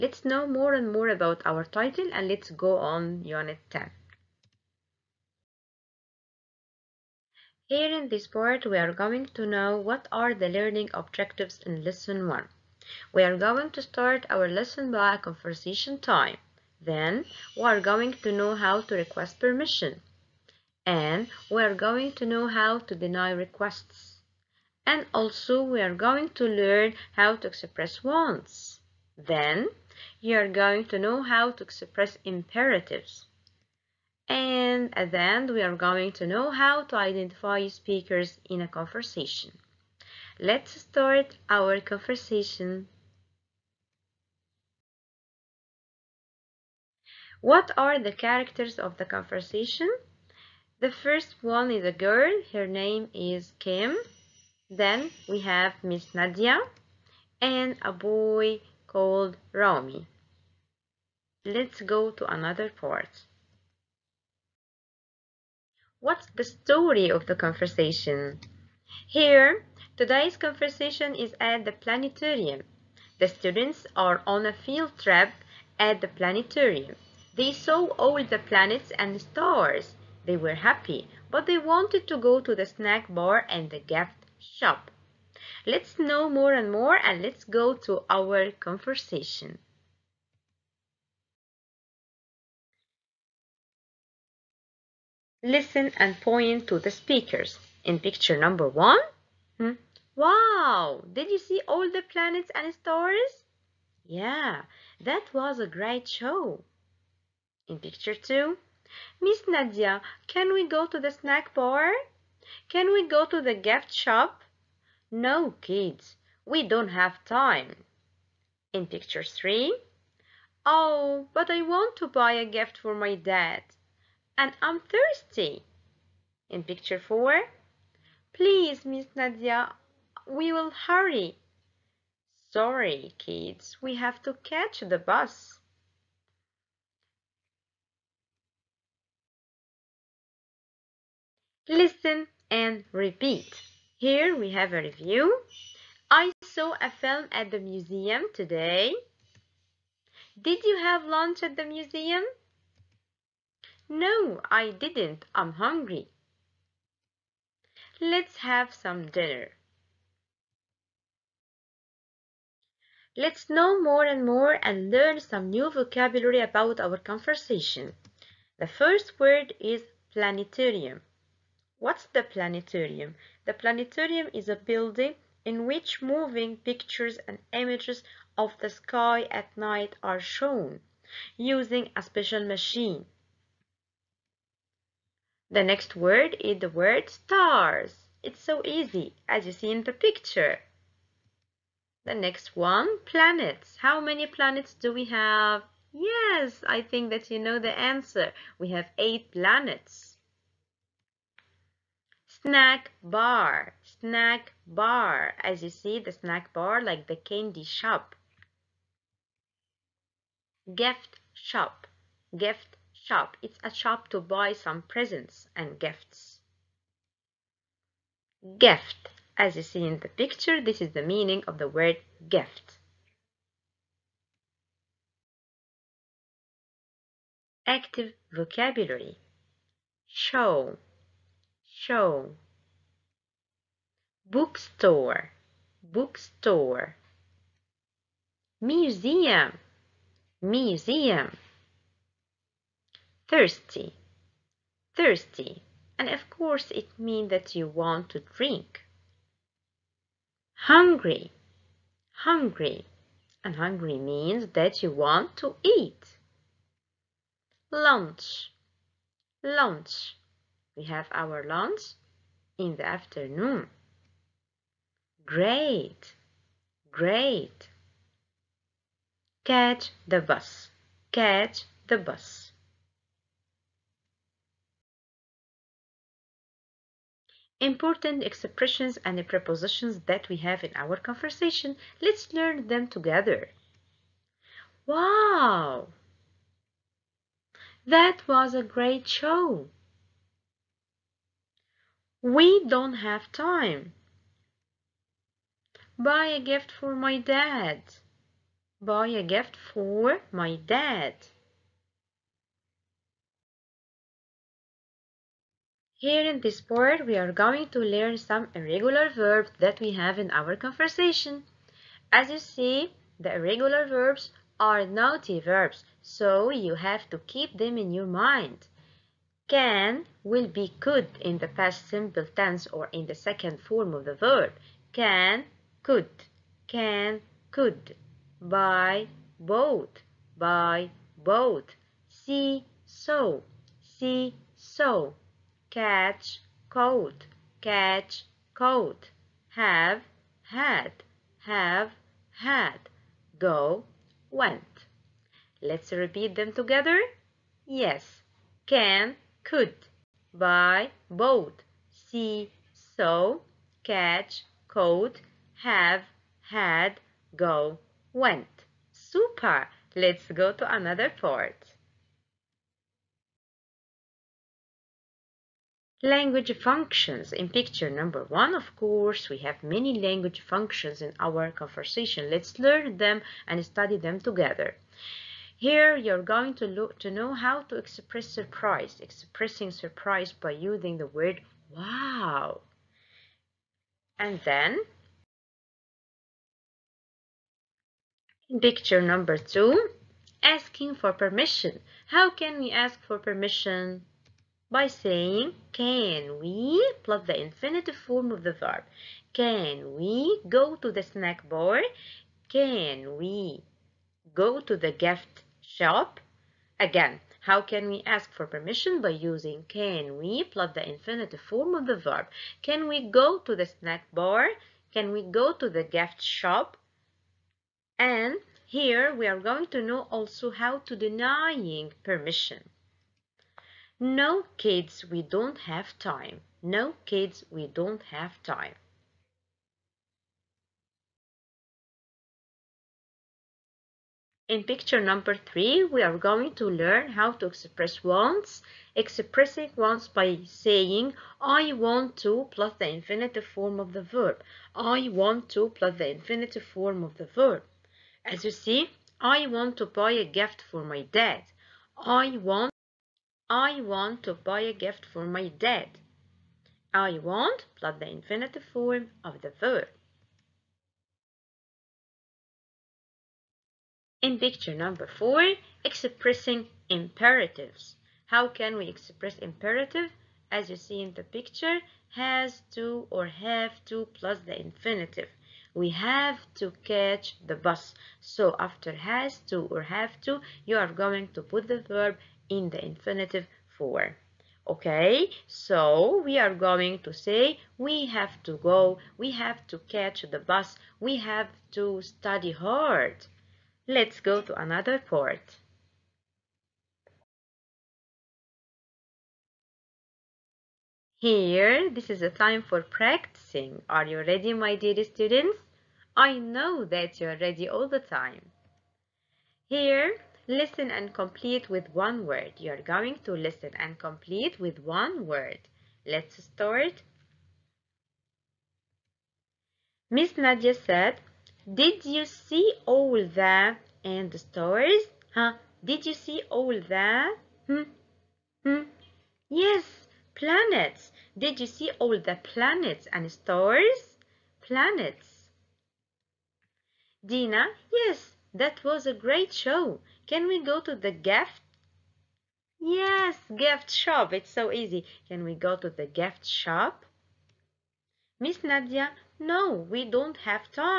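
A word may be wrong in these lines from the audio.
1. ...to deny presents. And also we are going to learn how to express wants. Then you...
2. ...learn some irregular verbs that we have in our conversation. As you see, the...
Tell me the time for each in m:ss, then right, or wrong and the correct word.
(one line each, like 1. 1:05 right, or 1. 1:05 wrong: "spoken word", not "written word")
1. 0:22 wrong: "requests", not "presents"
2. 5:07 right.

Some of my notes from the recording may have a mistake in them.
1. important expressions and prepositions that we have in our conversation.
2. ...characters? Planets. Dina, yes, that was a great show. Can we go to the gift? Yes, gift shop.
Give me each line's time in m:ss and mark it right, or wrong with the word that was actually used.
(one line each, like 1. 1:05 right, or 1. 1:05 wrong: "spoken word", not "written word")
1. 4:37 right
2. 8:53 wrong: "stars", not "characters".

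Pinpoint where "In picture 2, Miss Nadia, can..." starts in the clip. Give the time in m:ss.
1:47.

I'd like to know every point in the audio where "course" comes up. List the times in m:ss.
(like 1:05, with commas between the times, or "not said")
4:06, 6:08.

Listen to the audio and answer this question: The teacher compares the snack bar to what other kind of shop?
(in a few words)
The candy shop.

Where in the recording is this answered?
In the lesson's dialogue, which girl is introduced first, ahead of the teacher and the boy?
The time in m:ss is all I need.
0:53.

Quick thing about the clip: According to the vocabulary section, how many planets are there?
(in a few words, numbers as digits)
8.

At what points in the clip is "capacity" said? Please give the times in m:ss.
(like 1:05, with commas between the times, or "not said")
not said.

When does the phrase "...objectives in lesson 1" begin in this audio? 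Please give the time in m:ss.
0:10.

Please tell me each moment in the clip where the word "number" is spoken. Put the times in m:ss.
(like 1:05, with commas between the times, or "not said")
1:38, 6:07, 6:29, 7:15, 7:44.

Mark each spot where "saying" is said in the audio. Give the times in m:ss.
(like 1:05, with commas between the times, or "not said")
6:34, 7:20.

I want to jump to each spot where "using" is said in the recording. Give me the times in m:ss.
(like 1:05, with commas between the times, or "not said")
3:01, 6:20, 6:49.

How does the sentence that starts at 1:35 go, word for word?
Listen and point to the speakers.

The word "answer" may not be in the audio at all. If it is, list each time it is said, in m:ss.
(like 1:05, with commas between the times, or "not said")
3:17.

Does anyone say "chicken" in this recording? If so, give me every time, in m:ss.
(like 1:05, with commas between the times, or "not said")
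not said.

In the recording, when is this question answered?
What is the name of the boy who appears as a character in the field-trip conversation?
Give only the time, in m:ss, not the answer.
0:59.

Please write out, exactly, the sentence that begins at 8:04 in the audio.
Okay, so we are going to say we have to go, we have to catch the bus, we have to study hard.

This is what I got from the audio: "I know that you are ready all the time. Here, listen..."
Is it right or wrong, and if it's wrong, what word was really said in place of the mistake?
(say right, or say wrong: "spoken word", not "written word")
right.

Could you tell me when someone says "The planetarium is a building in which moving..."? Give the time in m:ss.
2:53.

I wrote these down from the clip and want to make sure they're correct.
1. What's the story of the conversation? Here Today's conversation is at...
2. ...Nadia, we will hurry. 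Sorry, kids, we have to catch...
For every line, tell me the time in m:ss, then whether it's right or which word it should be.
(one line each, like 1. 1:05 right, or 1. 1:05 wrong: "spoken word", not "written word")
1. 1:05 right
2. 2:09 right.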